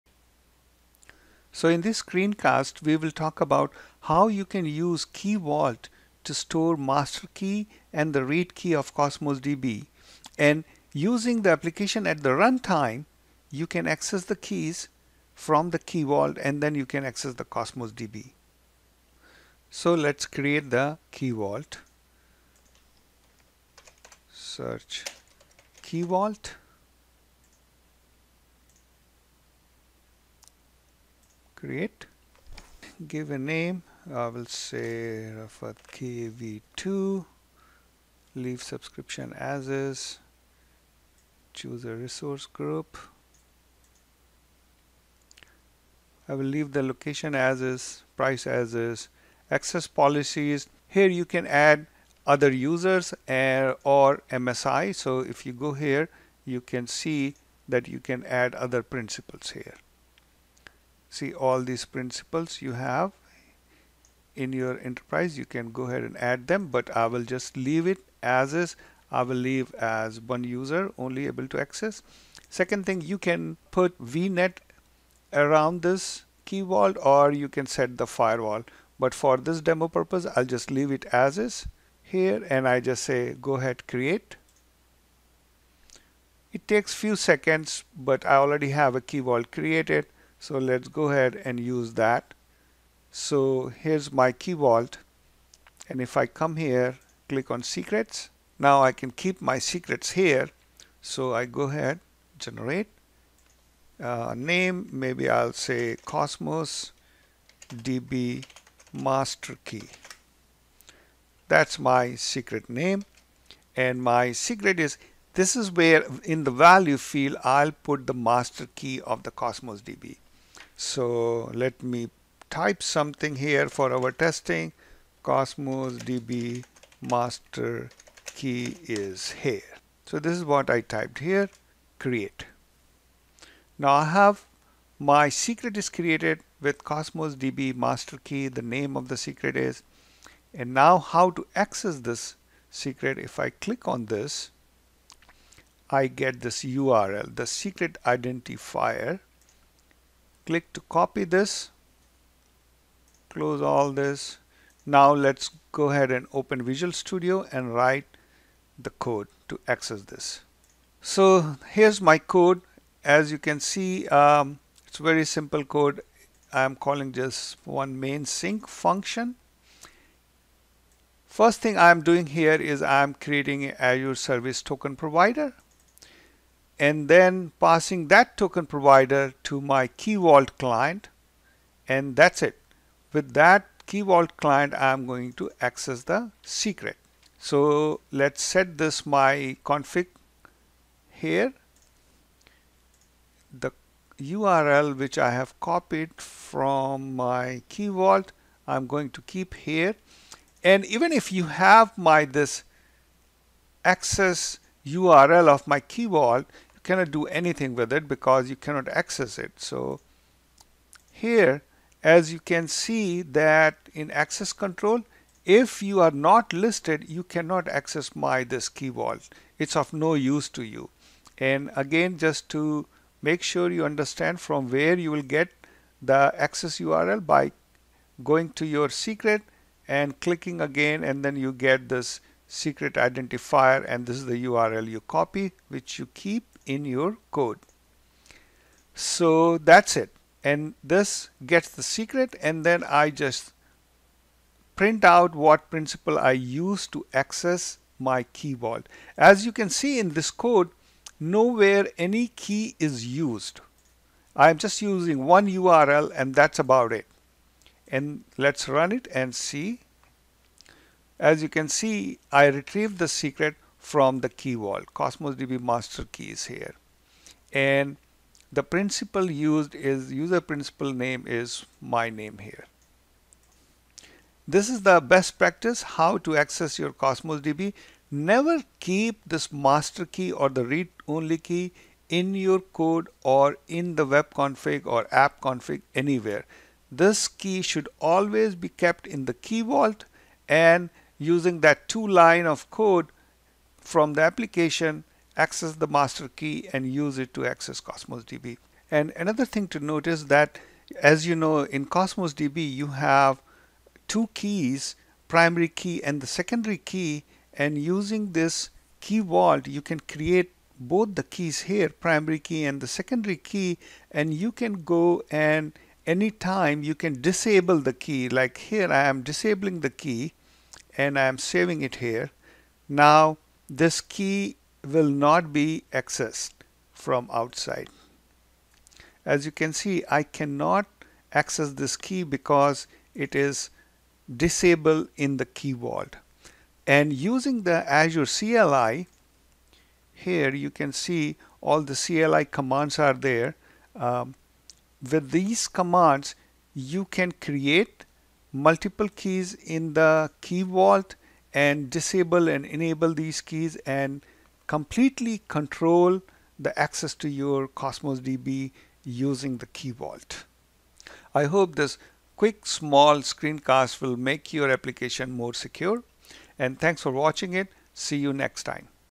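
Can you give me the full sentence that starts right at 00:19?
So let's create the key vault.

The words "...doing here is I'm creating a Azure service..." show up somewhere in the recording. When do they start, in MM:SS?
02:52.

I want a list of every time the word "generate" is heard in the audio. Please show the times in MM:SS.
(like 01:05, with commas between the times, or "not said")
01:42.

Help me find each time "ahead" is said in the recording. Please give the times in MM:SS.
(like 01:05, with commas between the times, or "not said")
01:05, 01:23, 01:31, 01:41, 02:35.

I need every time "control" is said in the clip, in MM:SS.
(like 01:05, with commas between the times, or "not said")
03:34, 05:55.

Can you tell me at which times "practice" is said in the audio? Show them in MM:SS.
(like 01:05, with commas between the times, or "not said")
04:35.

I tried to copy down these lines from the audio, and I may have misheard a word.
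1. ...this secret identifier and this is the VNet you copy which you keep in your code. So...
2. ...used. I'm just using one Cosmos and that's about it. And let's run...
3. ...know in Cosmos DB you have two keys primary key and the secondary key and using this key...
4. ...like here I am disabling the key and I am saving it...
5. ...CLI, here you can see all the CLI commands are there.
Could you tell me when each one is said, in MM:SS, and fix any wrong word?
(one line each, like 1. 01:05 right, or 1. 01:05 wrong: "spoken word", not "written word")
1. 03:51 wrong: "URL", not "VNet"
2. 04:13 wrong: "URL", not "Cosmos"
3. 05:01 right
4. 05:18 right
5. 05:38 right.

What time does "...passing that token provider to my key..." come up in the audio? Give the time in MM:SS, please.
02:57.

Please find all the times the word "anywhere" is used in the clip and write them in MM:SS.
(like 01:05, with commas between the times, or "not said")
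04:45.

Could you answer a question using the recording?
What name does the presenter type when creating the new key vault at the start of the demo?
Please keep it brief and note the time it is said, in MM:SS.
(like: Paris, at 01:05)
Rafat KV2, at 00:35.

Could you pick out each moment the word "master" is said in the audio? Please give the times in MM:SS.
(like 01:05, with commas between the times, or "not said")
00:06, 01:48, 01:58, 02:06, 02:17, 04:25, 04:39, 04:55.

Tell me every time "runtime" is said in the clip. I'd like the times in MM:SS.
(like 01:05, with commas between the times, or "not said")
00:12.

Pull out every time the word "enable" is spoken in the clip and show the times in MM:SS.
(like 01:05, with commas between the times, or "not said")
05:52.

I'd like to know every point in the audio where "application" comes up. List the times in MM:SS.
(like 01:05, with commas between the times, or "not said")
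00:11, 04:54, 06:04.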